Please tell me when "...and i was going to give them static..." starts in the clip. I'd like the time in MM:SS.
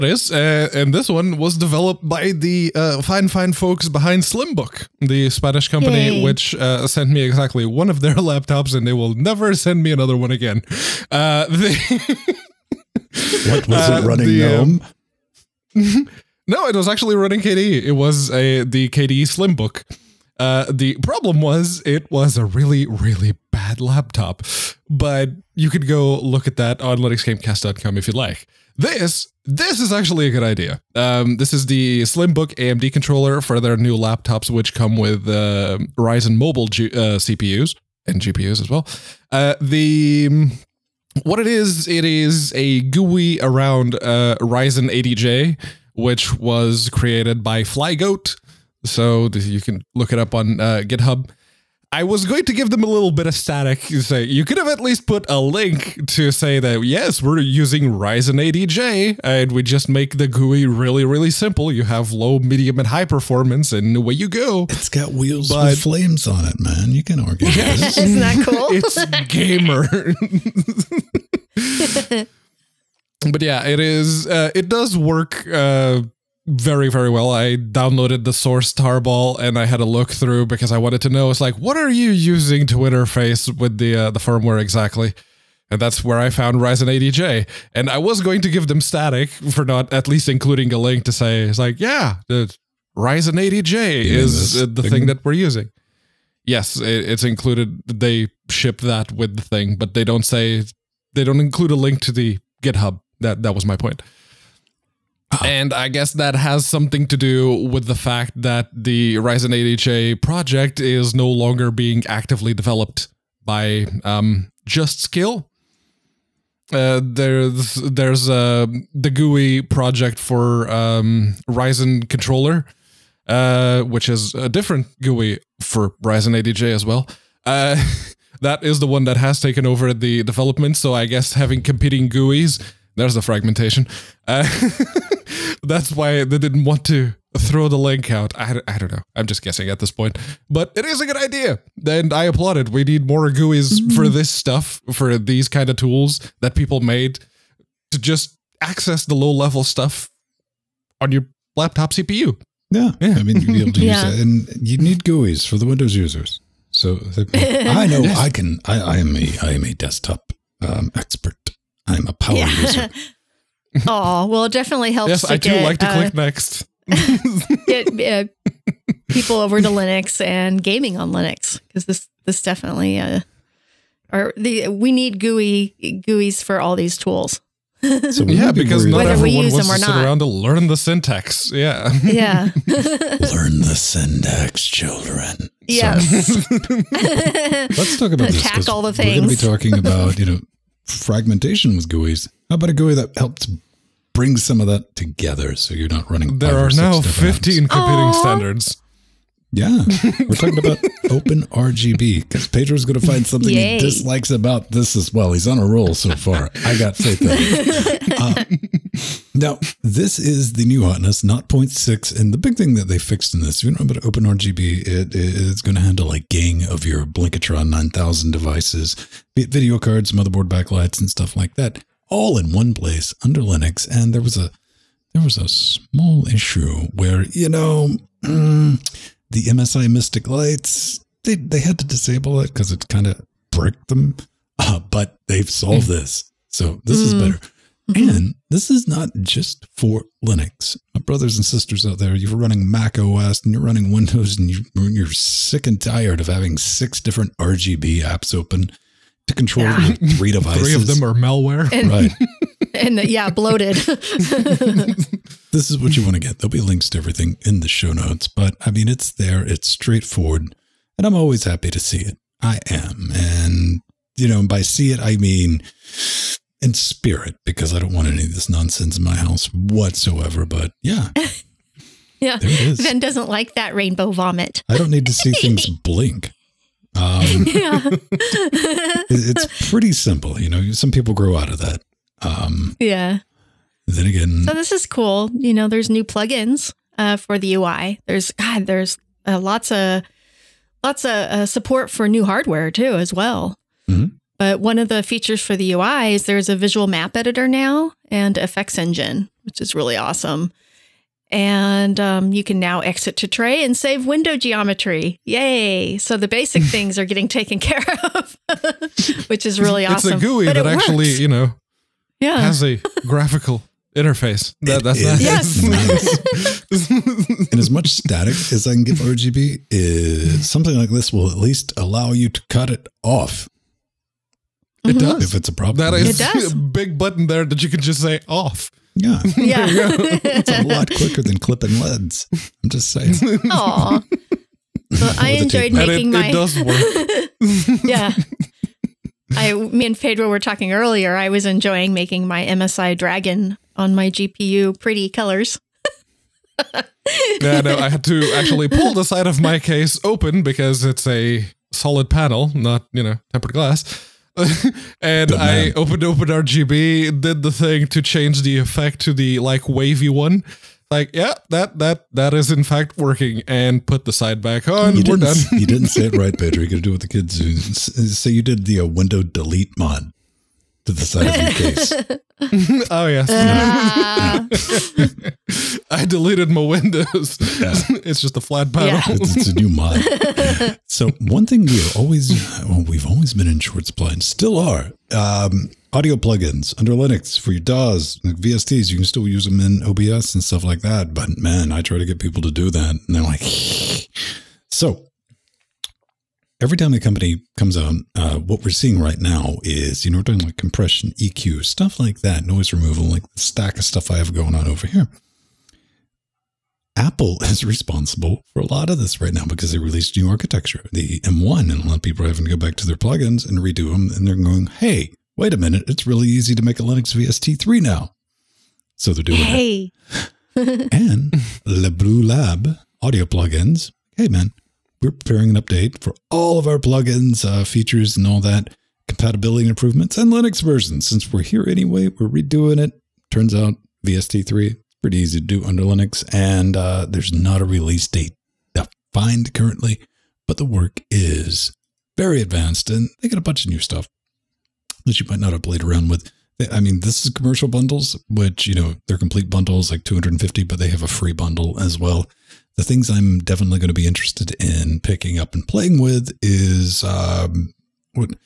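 01:27.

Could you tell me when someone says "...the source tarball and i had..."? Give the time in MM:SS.
01:18.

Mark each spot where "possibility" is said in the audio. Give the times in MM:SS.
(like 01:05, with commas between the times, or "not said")
not said.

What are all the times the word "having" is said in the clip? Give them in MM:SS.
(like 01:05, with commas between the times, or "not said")
02:11, 04:06, 06:52.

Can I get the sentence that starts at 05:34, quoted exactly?
Well, I enjoyed making it, my.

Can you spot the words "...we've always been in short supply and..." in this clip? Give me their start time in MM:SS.
06:22.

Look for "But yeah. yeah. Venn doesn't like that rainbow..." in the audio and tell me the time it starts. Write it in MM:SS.
04:30.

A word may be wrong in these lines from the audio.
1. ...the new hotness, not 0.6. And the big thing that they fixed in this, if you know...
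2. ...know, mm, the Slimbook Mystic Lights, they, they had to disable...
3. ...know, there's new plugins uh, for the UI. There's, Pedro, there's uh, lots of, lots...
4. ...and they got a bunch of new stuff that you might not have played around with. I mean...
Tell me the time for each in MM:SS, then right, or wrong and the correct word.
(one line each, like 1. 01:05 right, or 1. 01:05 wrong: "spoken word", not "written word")
1. 03:30 right
2. 03:47 wrong: "MSI", not "Slimbook"
3. 04:45 wrong: "God", not "Pedro"
4. 07:22 right.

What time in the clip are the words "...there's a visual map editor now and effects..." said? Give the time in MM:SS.
04:56.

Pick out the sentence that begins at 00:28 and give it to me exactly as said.
This, this is actually a good idea.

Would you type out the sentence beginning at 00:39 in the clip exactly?
Uh, the um, what it is, it is a GUI around uh, RyzenAdj, which was created by Flygoat.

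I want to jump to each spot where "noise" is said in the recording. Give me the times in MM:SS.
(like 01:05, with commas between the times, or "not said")
06:42.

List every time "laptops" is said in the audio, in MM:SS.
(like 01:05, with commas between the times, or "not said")
00:08, 00:23, 00:33, 02:31.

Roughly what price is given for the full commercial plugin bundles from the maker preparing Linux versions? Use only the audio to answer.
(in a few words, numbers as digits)
250.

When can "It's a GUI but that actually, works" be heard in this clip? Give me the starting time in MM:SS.
05:10.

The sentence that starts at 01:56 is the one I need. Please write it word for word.
Uh, there's there's uh, the GUI project for um, Ryzen controller, uh, which is a different GUI for Ryzen 8 as well.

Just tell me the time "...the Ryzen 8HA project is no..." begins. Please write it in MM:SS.
01:48.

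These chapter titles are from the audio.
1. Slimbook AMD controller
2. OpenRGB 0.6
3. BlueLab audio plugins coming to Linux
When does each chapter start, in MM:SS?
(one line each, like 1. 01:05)
1. 00:26
2. 03:21
3. 07:01.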